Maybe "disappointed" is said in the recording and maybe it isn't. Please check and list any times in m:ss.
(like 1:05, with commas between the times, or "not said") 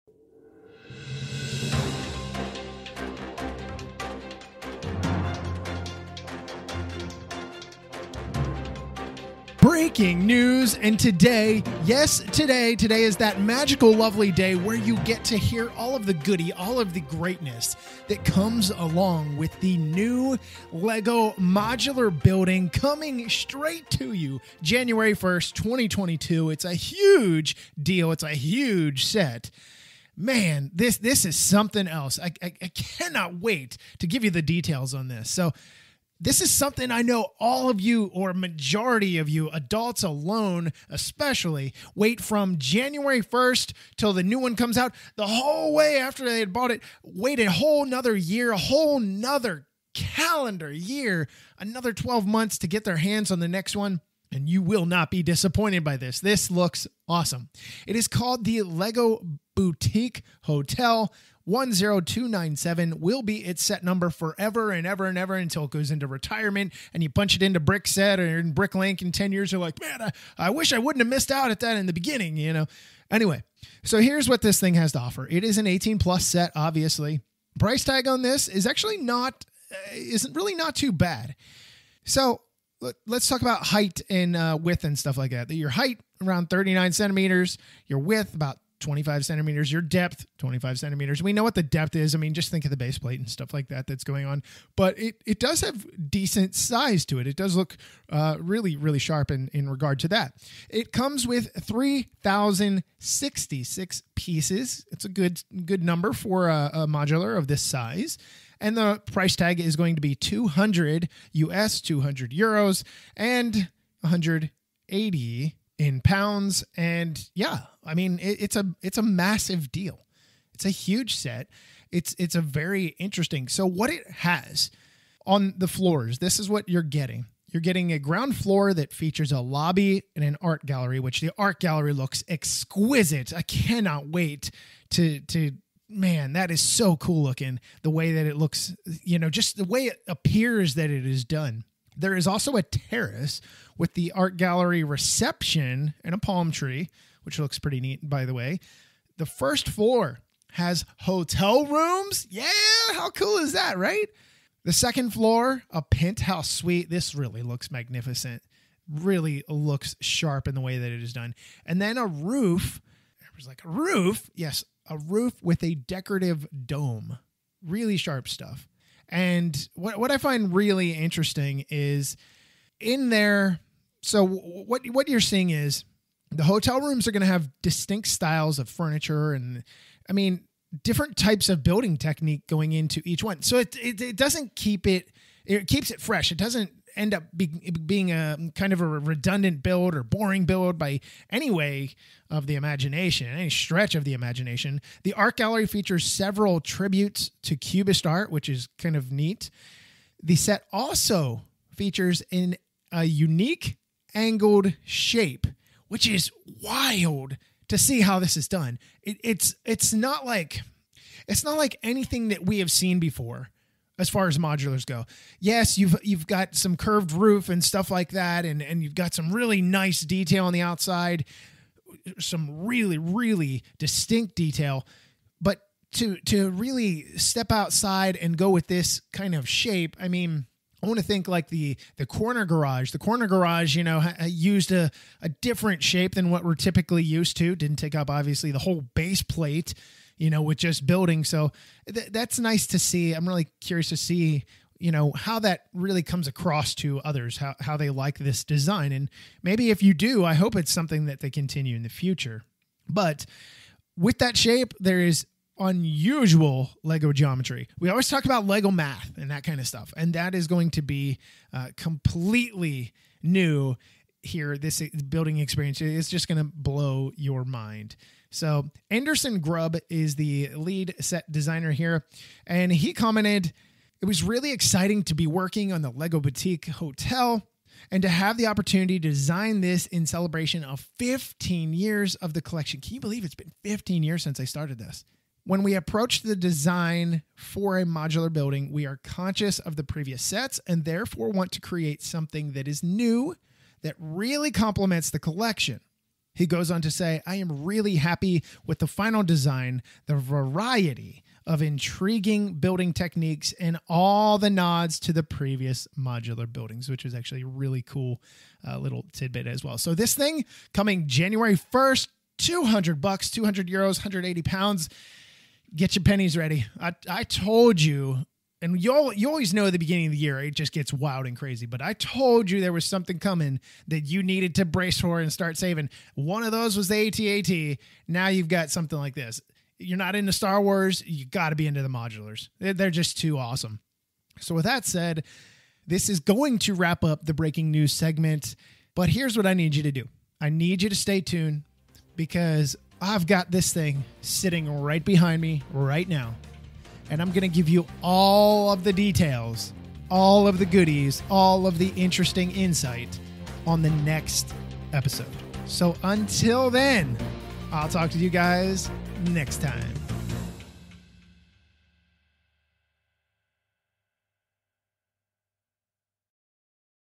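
0:55.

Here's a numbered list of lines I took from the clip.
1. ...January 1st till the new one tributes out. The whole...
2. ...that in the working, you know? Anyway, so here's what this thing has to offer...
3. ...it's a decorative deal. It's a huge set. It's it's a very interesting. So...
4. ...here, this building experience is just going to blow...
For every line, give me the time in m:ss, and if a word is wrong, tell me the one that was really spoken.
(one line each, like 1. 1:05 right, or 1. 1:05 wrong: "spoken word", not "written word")
1. 0:42 wrong: "comes", not "tributes"
2. 1:11 wrong: "beginning", not "working"
3. 1:58 wrong: "massive", not "decorative"
4. 4:24 right.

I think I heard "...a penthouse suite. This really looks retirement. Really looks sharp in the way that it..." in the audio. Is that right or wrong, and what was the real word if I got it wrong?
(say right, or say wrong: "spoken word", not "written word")
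wrong: "magnificent", not "retirement".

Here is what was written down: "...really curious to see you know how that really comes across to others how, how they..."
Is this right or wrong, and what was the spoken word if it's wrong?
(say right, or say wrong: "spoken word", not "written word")
right.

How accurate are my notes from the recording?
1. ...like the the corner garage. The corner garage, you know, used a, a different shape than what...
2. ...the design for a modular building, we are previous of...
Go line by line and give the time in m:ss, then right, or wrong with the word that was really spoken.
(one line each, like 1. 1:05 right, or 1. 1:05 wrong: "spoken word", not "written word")
1. 3:51 right
2. 4:46 wrong: "conscious", not "previous".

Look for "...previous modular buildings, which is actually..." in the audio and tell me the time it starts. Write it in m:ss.
5:05.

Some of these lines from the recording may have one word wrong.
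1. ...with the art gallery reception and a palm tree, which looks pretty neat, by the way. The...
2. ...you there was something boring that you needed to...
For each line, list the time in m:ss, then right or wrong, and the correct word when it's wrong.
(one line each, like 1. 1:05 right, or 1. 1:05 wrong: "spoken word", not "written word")
1. 2:23 right
2. 5:22 wrong: "coming", not "boring".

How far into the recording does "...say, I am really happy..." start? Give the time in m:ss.
4:56.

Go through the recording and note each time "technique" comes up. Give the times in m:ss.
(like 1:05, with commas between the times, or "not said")
3:01, 5:02.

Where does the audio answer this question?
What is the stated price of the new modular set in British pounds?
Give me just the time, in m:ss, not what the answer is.
1:54.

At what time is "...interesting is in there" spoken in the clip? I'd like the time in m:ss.
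2:50.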